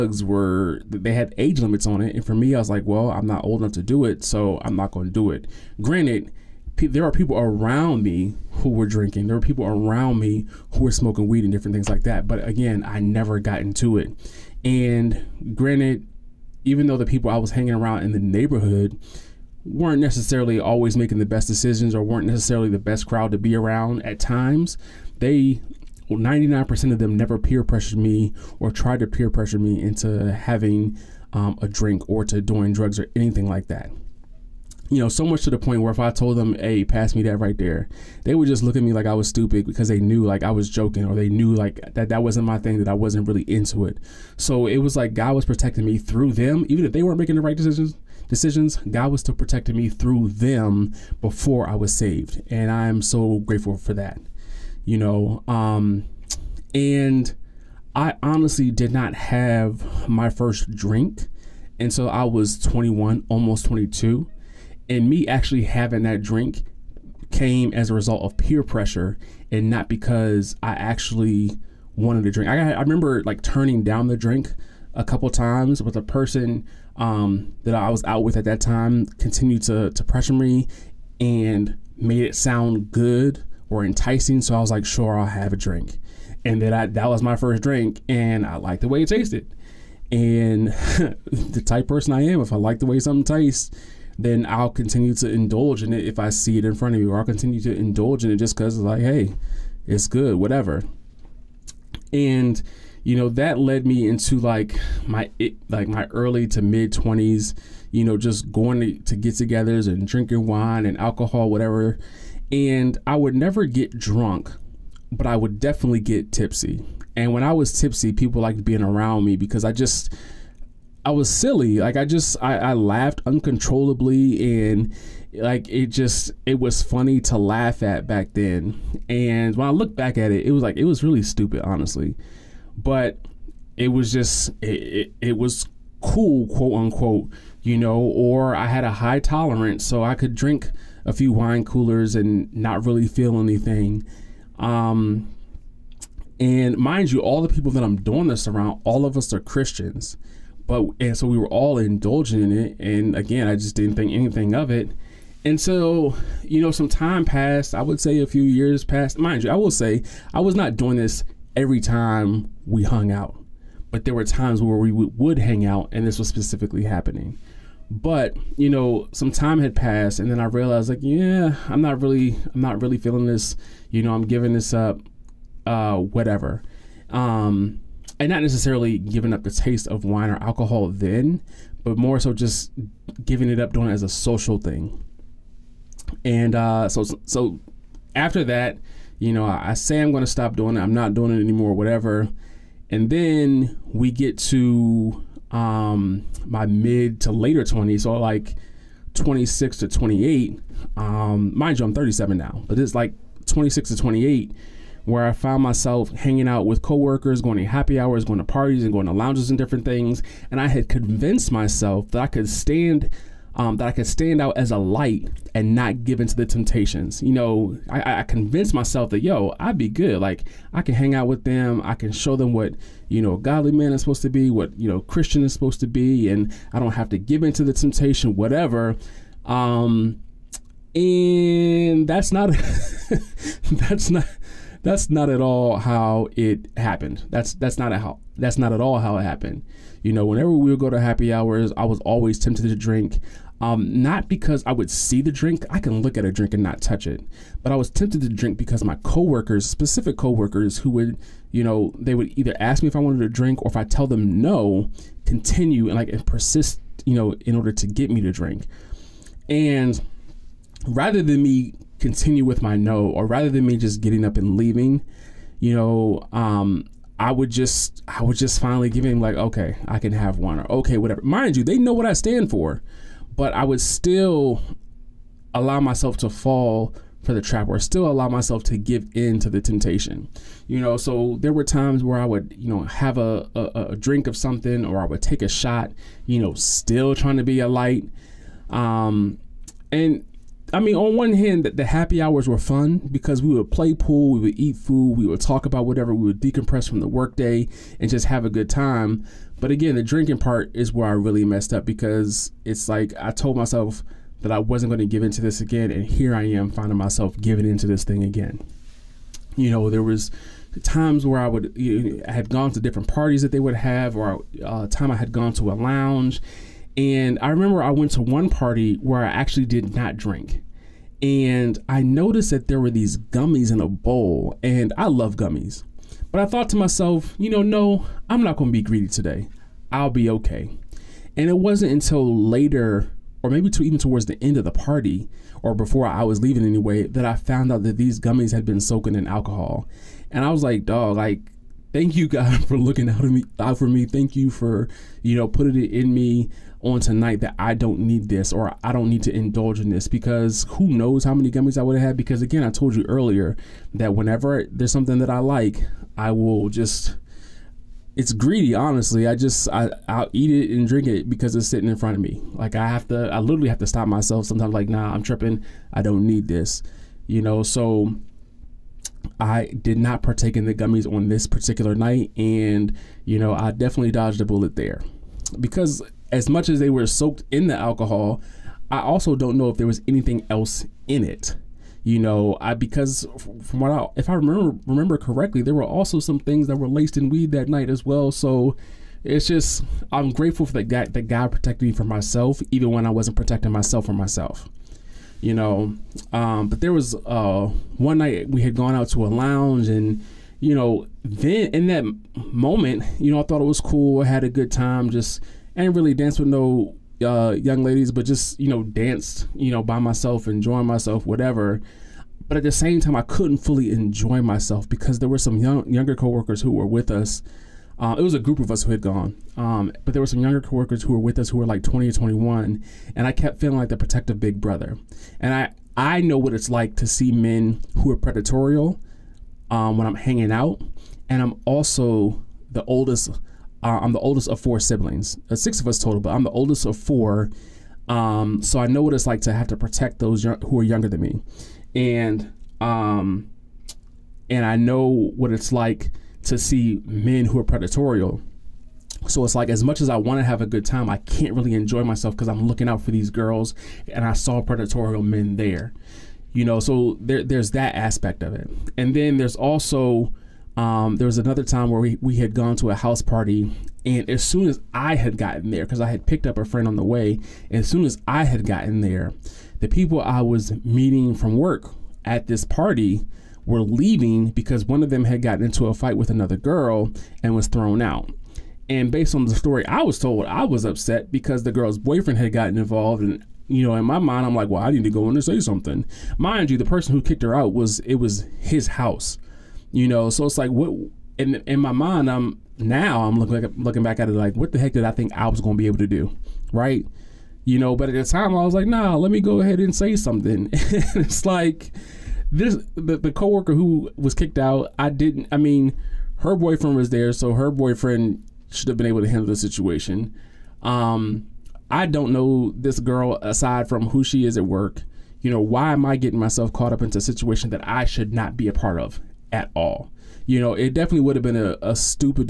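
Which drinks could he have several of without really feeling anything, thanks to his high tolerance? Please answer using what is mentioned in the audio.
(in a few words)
wine coolers.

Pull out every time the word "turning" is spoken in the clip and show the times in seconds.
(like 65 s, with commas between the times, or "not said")
73 s.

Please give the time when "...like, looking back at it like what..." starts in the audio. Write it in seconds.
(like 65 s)
493 s.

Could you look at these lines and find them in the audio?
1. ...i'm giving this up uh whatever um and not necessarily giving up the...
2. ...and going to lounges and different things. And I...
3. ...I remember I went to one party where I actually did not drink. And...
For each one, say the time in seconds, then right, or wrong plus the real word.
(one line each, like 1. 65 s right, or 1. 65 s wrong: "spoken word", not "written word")
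1. 174 s right
2. 208 s right
3. 317 s right.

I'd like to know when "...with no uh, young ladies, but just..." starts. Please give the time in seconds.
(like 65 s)
406 s.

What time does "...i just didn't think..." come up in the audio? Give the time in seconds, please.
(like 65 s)
153 s.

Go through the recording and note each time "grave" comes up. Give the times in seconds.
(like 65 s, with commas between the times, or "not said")
not said.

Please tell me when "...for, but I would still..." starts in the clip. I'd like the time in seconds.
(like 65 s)
272 s.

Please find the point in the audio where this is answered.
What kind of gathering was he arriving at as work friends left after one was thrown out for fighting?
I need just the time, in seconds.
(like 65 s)
462 s.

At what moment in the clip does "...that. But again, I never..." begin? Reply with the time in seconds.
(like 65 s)
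12 s.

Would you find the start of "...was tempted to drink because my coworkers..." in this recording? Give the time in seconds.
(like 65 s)
247 s.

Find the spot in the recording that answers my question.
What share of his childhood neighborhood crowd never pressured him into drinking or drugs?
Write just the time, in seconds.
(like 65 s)
26 s.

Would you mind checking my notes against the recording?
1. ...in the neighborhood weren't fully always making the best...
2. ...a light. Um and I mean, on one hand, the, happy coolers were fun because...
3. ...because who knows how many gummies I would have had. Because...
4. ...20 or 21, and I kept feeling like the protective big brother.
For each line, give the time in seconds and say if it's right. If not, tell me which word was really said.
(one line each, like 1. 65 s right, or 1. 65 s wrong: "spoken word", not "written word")
1. 18 s wrong: "necessarily", not "fully"
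2. 287 s wrong: "hours", not "coolers"
3. 350 s right
4. 421 s right.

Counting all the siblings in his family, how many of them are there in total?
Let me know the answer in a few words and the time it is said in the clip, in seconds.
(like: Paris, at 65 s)
6, at 435 s.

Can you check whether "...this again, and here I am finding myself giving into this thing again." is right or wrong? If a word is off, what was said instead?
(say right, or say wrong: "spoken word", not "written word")
right.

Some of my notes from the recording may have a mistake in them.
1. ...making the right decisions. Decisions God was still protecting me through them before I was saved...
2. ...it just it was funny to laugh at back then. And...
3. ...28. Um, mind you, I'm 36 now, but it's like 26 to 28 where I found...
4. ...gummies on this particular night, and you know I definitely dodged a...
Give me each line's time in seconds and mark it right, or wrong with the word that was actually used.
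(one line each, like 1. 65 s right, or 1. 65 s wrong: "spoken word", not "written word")
1. 47 s right
2. 125 s right
3. 199 s wrong: "37", not "36"
4. 370 s right.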